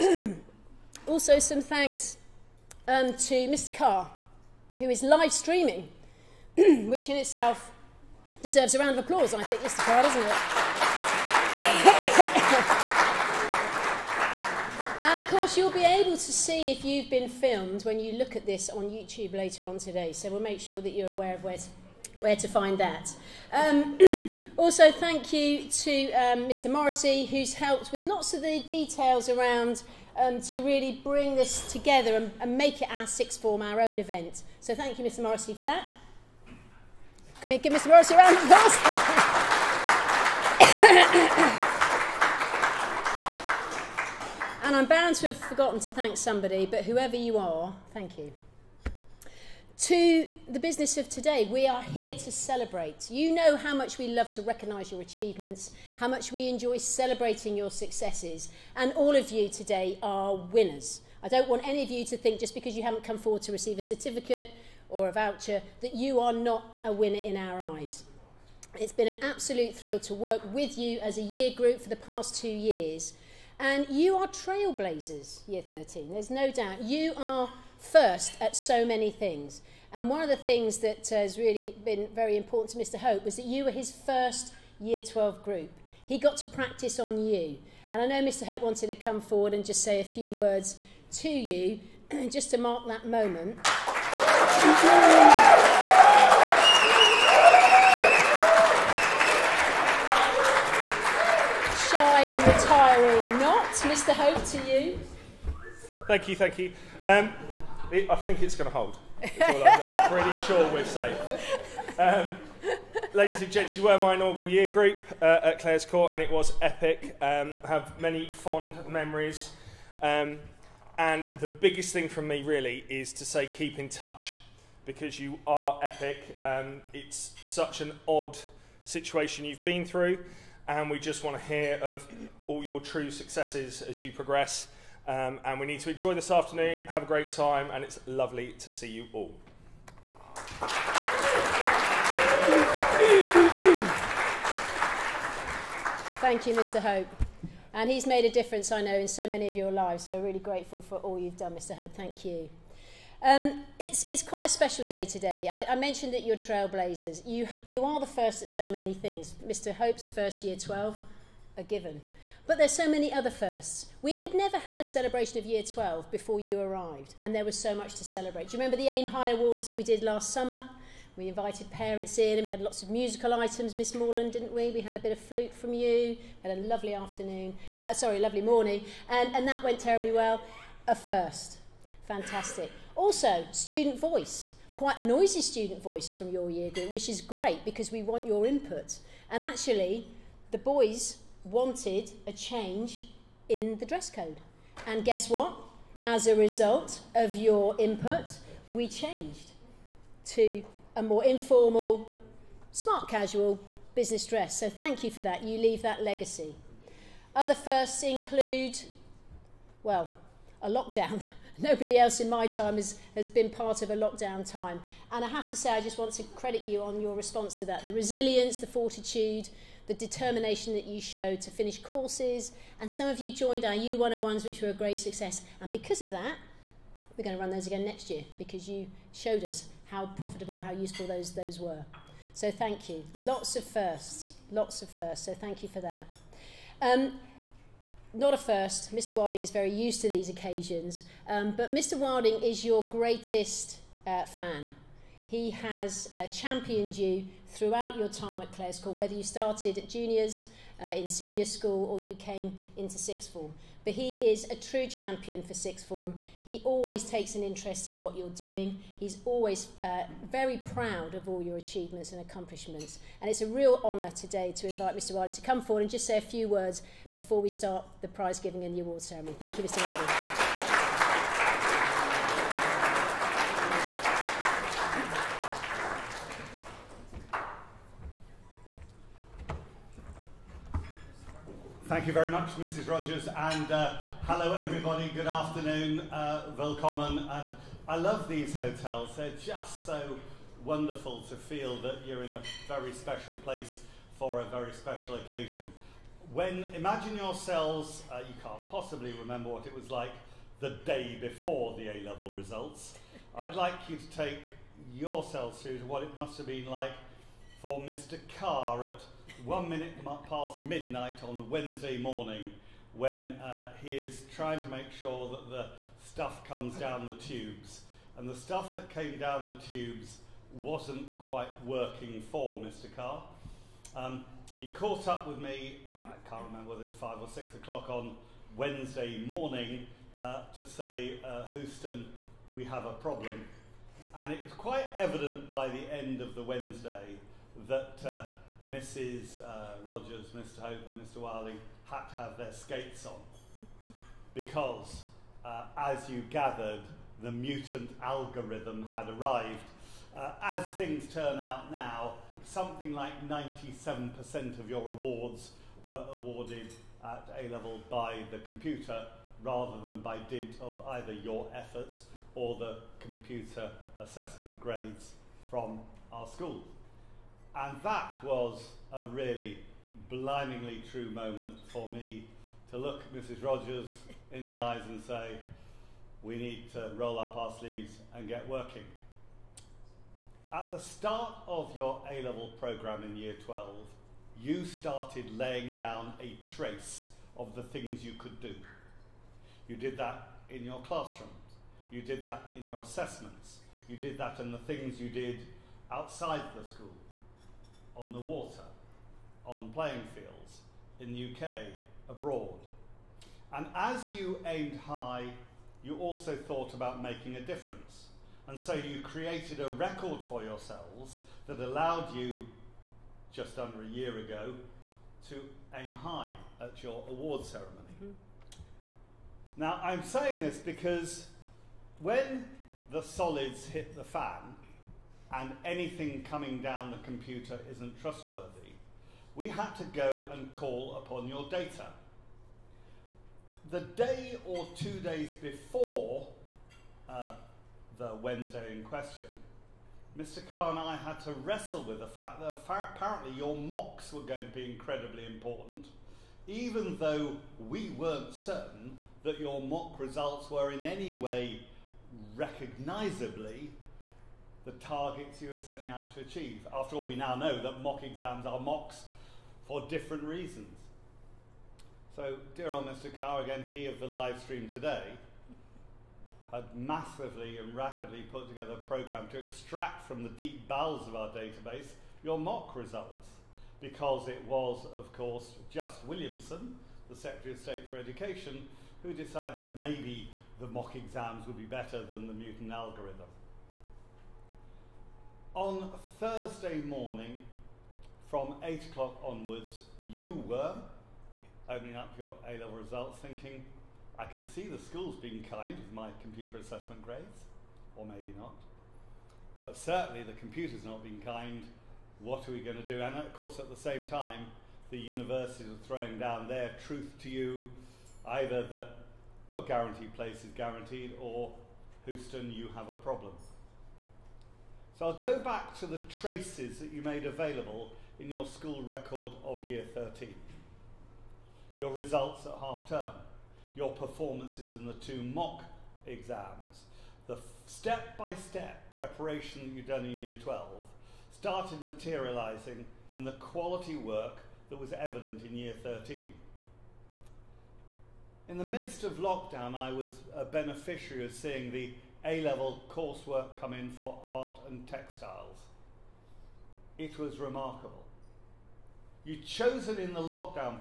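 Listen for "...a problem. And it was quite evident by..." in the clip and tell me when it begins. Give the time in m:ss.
5:32.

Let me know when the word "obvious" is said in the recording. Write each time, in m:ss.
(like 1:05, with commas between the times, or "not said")
not said.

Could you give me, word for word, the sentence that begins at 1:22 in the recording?
Hope was that you were his first year 12 group.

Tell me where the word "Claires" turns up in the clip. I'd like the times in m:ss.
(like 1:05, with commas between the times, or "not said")
1:55, 4:08.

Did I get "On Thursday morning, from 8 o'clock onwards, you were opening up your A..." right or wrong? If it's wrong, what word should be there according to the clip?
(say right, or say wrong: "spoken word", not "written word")
right.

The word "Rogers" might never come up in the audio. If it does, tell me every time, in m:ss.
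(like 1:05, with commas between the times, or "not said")
4:42, 5:39, 6:13.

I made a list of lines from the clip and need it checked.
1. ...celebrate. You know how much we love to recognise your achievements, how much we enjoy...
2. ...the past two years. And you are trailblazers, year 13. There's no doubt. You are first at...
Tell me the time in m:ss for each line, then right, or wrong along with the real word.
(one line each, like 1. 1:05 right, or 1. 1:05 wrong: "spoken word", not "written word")
1. 0:52 right
2. 1:11 right.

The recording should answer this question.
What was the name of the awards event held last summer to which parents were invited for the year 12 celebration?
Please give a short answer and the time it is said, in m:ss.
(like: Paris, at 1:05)
Aim High Awards, at 2:48.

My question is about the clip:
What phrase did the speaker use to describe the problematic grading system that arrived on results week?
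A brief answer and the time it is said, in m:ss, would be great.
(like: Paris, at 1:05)
mutant algorithm, at 5:47.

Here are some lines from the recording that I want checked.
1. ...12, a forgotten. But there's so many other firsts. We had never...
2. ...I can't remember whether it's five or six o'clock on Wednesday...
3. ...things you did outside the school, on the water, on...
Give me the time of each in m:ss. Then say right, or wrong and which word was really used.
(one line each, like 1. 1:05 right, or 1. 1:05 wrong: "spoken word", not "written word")
1. 2:40 wrong: "given", not "forgotten"
2. 5:26 right
3. 6:34 right.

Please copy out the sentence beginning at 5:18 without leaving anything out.
And the stuff that came down the tubes wasn't quite working for Mr.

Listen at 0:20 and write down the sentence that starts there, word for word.
So we'll make sure that you're aware of where to where to find that.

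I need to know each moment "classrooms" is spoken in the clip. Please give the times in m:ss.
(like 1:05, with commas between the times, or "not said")
6:30.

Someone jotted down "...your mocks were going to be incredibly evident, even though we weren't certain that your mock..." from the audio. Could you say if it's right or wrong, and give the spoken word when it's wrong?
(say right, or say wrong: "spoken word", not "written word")
wrong: "important", not "evident".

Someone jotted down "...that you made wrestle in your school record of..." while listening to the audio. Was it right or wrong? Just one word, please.
wrong.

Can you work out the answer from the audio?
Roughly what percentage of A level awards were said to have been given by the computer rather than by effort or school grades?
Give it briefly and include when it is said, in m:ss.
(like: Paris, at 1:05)
97%, at 5:53.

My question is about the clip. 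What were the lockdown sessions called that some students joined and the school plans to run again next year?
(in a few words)
U101s.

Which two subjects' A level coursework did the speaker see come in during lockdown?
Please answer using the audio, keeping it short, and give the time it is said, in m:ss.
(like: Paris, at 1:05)
art and textiles, at 9:04.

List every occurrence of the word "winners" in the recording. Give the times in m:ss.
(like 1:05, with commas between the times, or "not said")
1:00, 1:06.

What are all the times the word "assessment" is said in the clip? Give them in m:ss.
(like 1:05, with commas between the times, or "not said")
6:03, 6:32, 8:16.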